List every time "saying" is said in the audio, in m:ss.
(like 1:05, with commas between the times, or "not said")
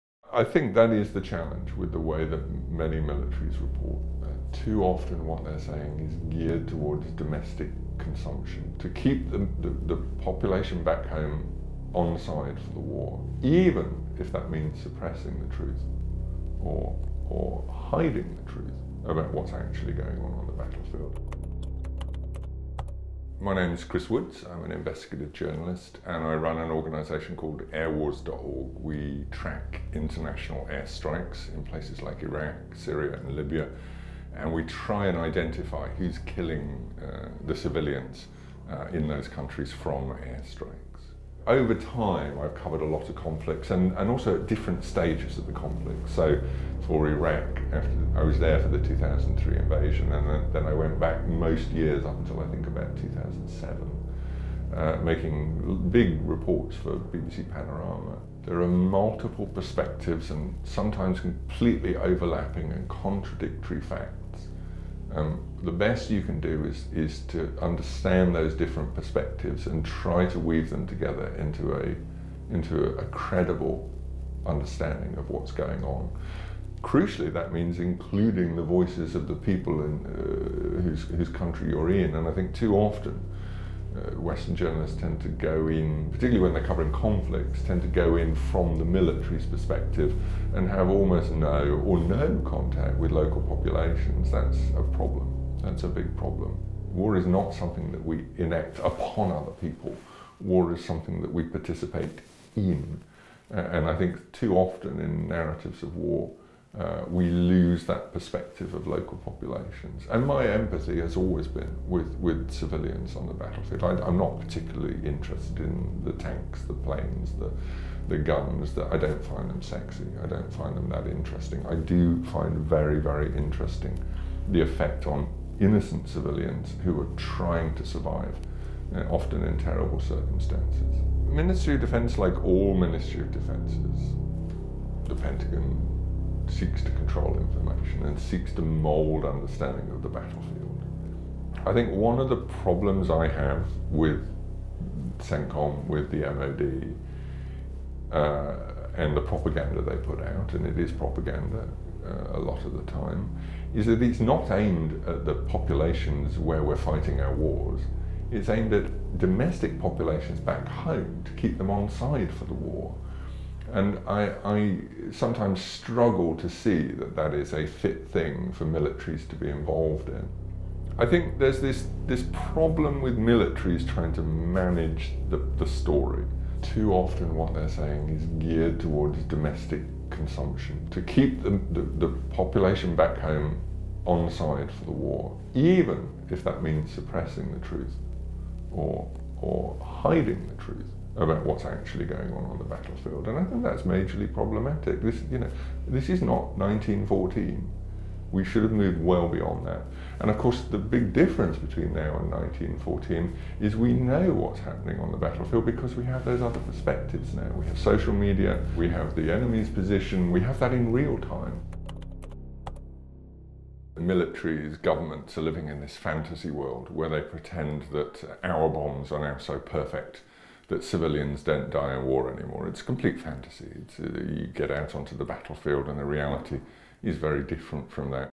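0:05, 2:57.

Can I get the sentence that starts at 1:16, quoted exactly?
Crucially, that means including the voices of the people in, uh, whose, whose country you're in.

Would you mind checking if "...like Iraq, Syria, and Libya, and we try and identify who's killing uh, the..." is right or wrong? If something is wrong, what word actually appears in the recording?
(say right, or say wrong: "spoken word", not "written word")
right.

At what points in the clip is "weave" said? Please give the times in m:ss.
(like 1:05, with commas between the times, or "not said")
1:10.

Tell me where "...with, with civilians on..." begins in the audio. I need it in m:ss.
1:51.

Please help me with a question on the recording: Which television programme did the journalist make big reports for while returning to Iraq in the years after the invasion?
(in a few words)
BBC Panorama.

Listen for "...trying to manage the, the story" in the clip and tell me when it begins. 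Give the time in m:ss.
2:53.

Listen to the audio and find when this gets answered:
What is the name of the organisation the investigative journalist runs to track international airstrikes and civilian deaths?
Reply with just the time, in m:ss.
0:27.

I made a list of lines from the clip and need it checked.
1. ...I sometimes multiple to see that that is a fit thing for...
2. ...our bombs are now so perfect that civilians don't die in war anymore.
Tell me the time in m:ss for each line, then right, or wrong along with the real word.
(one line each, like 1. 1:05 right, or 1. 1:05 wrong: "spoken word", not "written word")
1. 2:44 wrong: "struggle", not "multiple"
2. 3:38 right.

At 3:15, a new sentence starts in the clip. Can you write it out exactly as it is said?
This, you know, this is not 1914.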